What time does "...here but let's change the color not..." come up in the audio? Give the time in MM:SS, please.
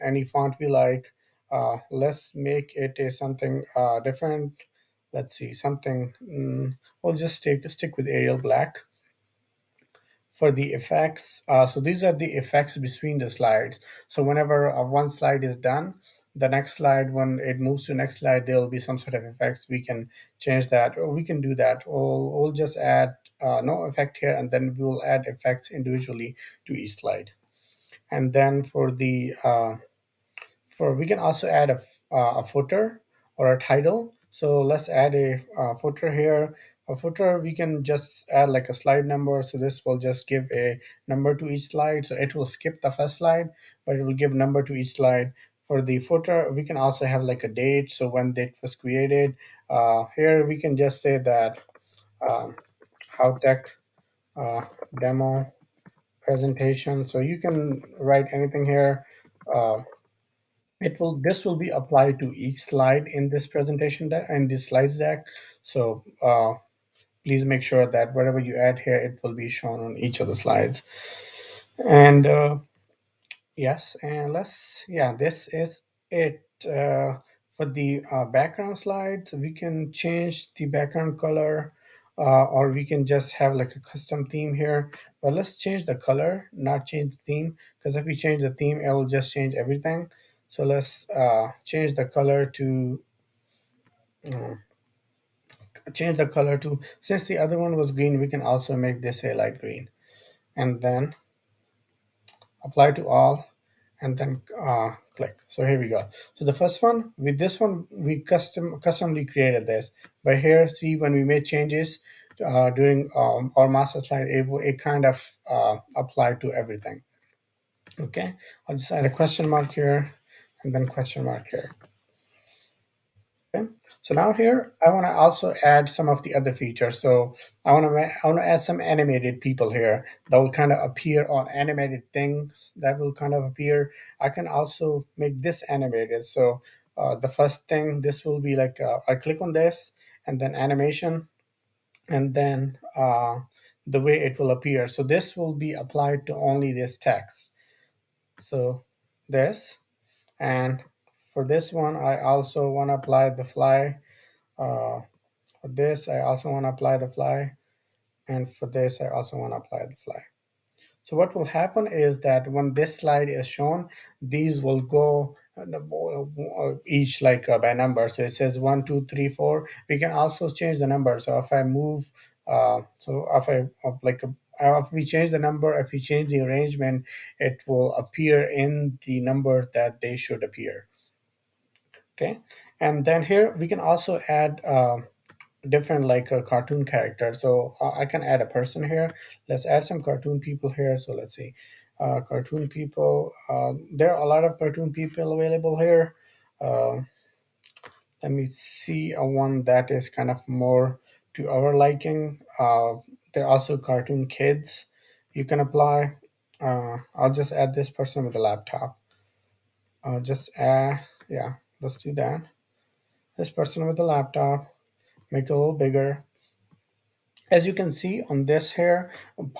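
01:24.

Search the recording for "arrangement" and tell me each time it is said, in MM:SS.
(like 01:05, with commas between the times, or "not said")
02:56.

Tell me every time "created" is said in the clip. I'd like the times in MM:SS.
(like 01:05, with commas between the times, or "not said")
00:48, 01:49.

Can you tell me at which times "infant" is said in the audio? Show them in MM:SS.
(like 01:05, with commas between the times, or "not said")
not said.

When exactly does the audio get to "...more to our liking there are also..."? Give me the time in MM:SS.
03:20.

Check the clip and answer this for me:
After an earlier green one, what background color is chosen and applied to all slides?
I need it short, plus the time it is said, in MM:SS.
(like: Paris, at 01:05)
light green, at 01:39.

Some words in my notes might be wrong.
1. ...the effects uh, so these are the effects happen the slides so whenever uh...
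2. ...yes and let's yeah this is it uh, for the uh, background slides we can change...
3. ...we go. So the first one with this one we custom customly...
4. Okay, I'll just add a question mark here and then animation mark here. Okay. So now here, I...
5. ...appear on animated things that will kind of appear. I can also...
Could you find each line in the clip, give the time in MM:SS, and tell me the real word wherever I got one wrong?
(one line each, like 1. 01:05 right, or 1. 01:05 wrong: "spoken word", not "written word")
1. 00:10 wrong: "between", not "happen"
2. 01:13 right
3. 01:45 right
4. 01:57 wrong: "question", not "animation"
5. 02:10 right.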